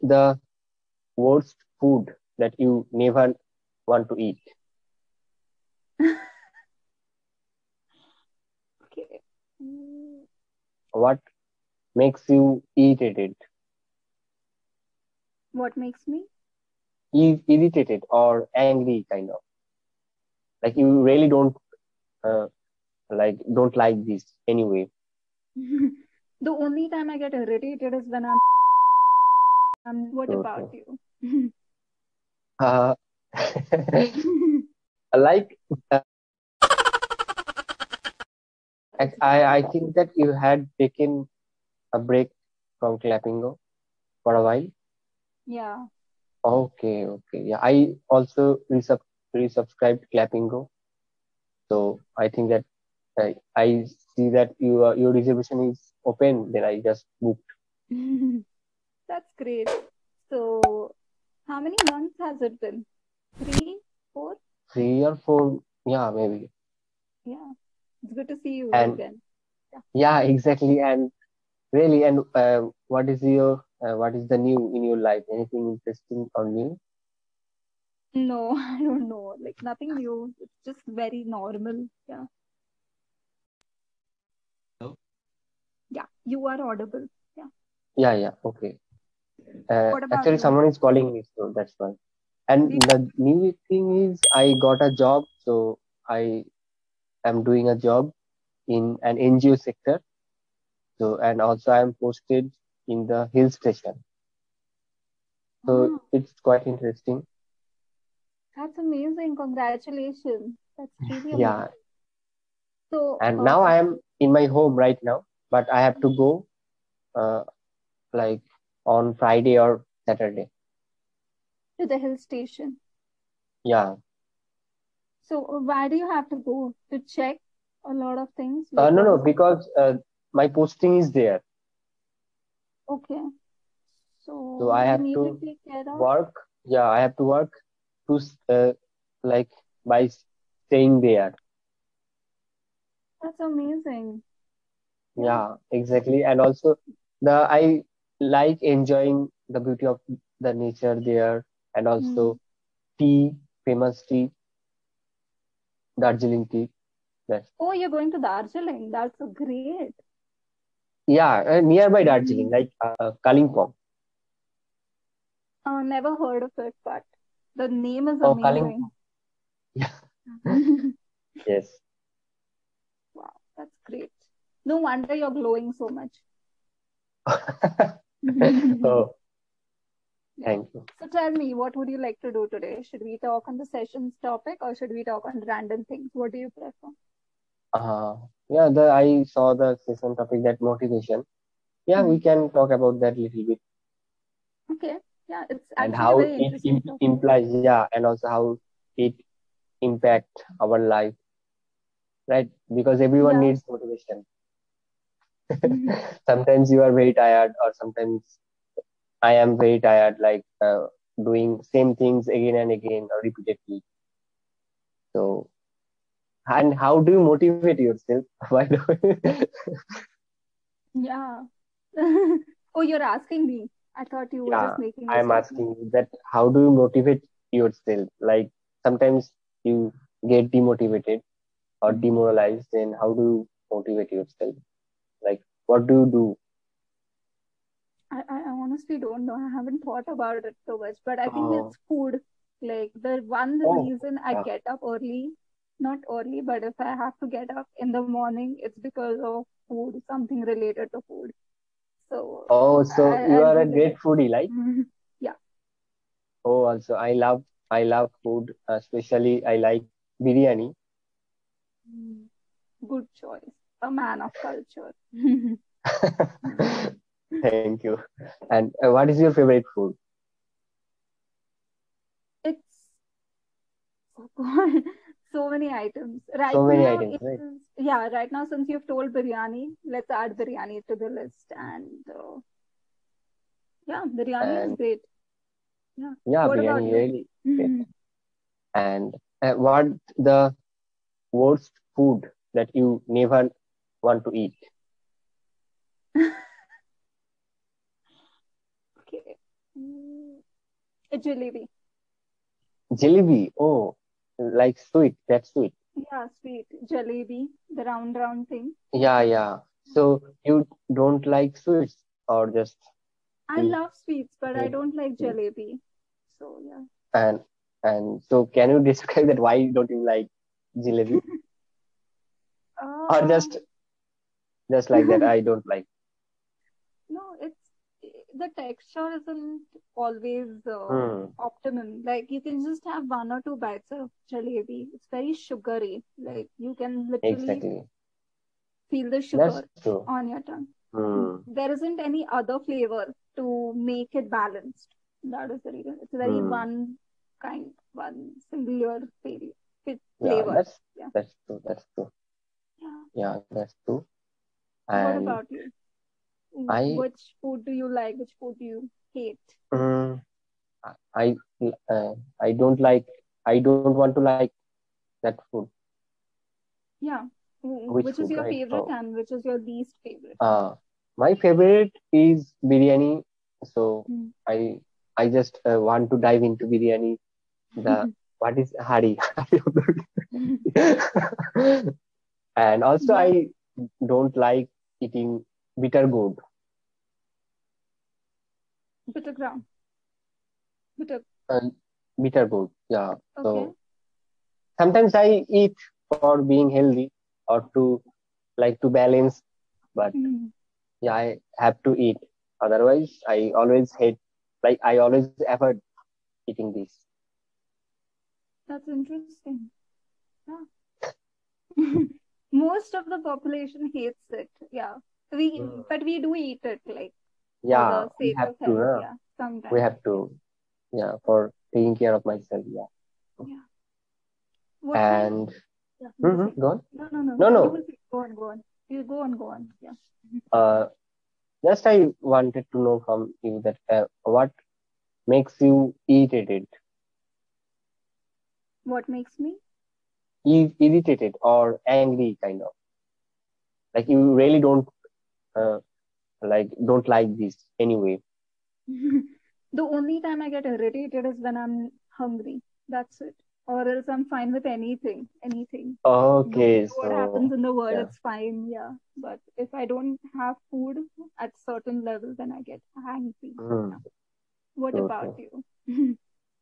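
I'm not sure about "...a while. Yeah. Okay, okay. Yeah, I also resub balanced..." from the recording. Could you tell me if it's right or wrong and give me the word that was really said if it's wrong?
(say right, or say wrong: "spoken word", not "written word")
wrong: "resubscribed", not "balanced".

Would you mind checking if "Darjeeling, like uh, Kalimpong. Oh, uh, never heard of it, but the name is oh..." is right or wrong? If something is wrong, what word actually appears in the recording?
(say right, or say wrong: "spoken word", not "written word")
right.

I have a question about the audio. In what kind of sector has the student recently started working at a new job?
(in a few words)
NGO sector.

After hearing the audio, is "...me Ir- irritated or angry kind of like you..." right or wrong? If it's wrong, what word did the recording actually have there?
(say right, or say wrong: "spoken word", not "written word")
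right.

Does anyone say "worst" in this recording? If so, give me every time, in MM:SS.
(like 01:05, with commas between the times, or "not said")
00:01, 04:51.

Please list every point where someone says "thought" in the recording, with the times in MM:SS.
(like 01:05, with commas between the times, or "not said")
03:44, 03:59.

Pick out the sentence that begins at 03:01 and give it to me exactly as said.
So tell me, what would you like to do today?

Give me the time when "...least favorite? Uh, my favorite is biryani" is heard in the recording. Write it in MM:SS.
06:09.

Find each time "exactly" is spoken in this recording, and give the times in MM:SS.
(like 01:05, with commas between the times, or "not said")
01:10, 02:25, 05:37.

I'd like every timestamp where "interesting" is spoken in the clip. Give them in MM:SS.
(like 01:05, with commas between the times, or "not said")
01:15, 01:46, 06:48.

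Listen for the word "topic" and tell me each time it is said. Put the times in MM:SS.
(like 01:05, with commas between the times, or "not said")
03:04, 03:10.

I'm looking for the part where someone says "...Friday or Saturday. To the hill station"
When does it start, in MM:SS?
01:59.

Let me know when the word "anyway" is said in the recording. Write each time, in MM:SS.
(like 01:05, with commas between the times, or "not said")
00:24, 07:27.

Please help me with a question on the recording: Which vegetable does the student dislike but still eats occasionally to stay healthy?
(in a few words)
Bitter gourd.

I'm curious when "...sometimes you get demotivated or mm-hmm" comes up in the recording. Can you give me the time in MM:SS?
03:48.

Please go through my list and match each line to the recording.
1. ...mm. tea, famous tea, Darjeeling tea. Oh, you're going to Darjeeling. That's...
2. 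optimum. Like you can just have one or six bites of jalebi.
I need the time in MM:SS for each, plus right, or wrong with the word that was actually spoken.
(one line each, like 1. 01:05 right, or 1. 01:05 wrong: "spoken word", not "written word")
1. 02:32 right
2. 05:31 wrong: "two", not "six".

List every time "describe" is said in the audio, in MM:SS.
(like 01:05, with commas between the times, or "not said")
05:18.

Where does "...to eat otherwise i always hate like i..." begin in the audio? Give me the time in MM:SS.
06:41.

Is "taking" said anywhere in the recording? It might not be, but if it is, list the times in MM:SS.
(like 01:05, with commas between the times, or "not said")
07:01.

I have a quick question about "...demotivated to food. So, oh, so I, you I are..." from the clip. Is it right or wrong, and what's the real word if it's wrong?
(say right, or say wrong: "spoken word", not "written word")
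wrong: "related", not "demotivated".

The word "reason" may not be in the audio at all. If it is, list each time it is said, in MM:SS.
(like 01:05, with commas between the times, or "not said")
04:03, 05:45.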